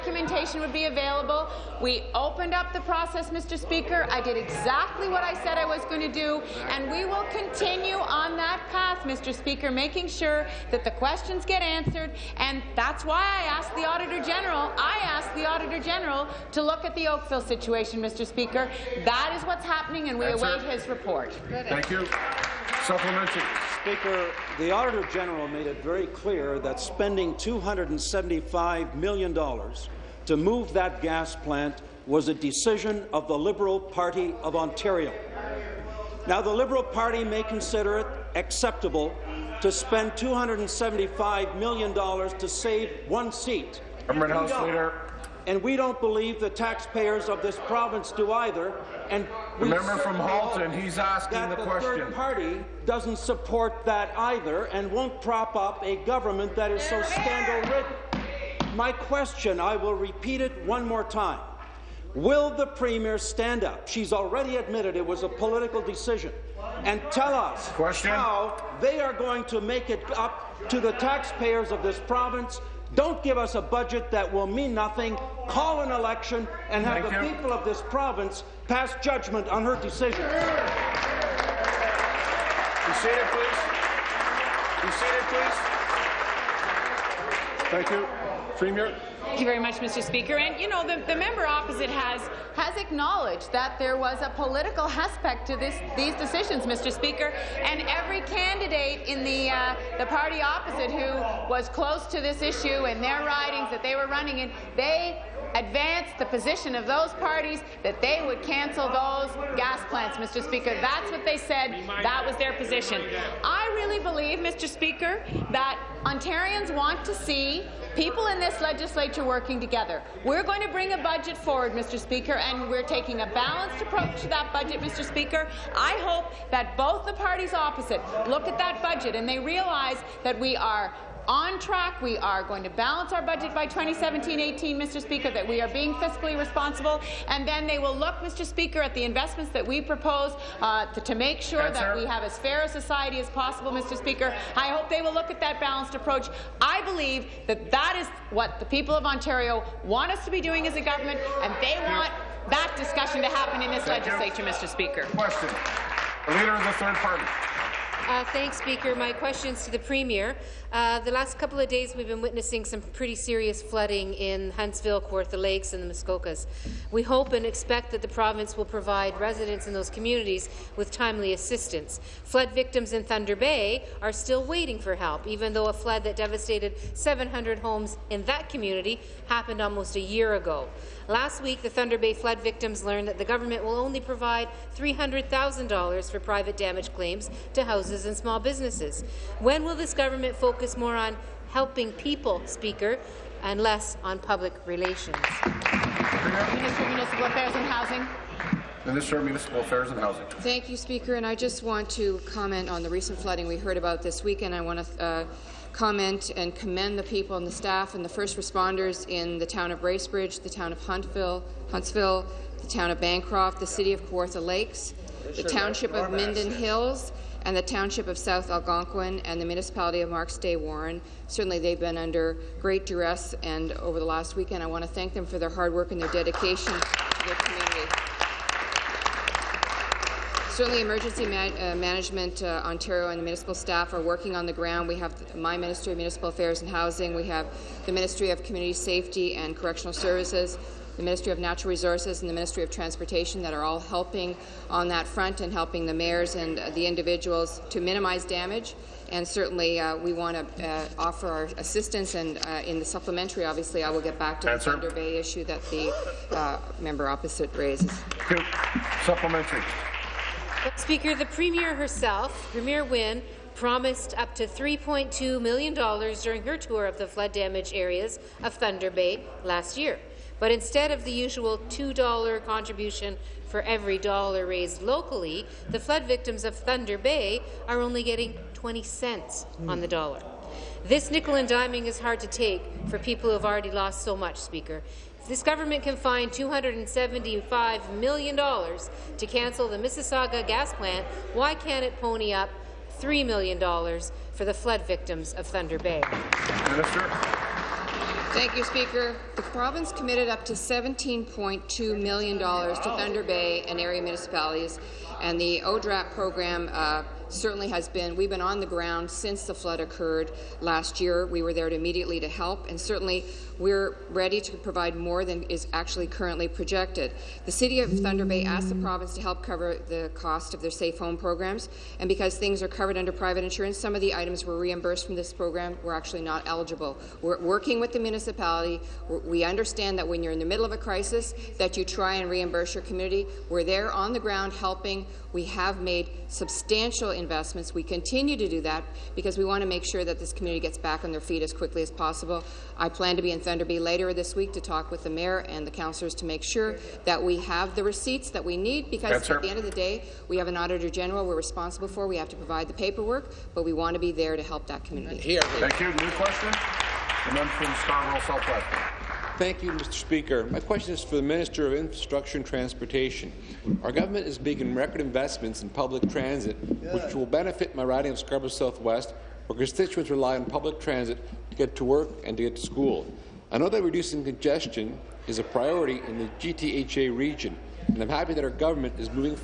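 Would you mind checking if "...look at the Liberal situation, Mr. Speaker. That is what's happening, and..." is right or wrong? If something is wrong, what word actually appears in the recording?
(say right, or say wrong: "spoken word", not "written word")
wrong: "Oakville", not "Liberal".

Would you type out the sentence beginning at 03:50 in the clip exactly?
Certainly, Emergency man uh, Management uh, Ontario and the municipal staff are working on the ground.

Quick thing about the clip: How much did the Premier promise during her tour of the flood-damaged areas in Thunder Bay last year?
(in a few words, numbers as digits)
$3.2 million.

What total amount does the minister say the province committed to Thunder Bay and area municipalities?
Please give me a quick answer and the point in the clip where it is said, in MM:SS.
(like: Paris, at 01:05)
$17.2 million, at 05:00.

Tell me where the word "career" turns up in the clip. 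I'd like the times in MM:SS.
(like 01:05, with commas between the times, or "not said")
not said.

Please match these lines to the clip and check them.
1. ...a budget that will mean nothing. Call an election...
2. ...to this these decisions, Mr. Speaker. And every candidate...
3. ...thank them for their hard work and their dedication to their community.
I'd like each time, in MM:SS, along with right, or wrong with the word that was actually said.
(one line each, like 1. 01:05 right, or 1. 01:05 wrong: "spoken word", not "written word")
1. 01:13 right
2. 01:35 right
3. 03:44 right.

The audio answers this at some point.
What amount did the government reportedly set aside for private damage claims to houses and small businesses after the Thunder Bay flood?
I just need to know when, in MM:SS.
03:04.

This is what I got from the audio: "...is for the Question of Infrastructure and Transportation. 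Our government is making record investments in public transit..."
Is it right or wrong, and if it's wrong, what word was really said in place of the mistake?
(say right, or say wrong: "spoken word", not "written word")
wrong: "Minister", not "Question".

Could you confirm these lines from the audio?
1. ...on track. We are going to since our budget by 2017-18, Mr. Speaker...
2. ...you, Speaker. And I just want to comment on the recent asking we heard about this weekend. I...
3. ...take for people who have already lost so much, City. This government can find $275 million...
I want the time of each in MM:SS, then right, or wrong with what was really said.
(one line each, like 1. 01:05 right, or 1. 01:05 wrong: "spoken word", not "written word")
1. 02:11 wrong: "balance", not "since"
2. 03:20 wrong: "flooding", not "asking"
3. 04:42 wrong: "Speaker", not "City".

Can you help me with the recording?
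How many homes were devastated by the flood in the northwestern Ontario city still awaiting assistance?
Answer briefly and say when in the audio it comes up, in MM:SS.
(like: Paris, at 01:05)
700, at 02:56.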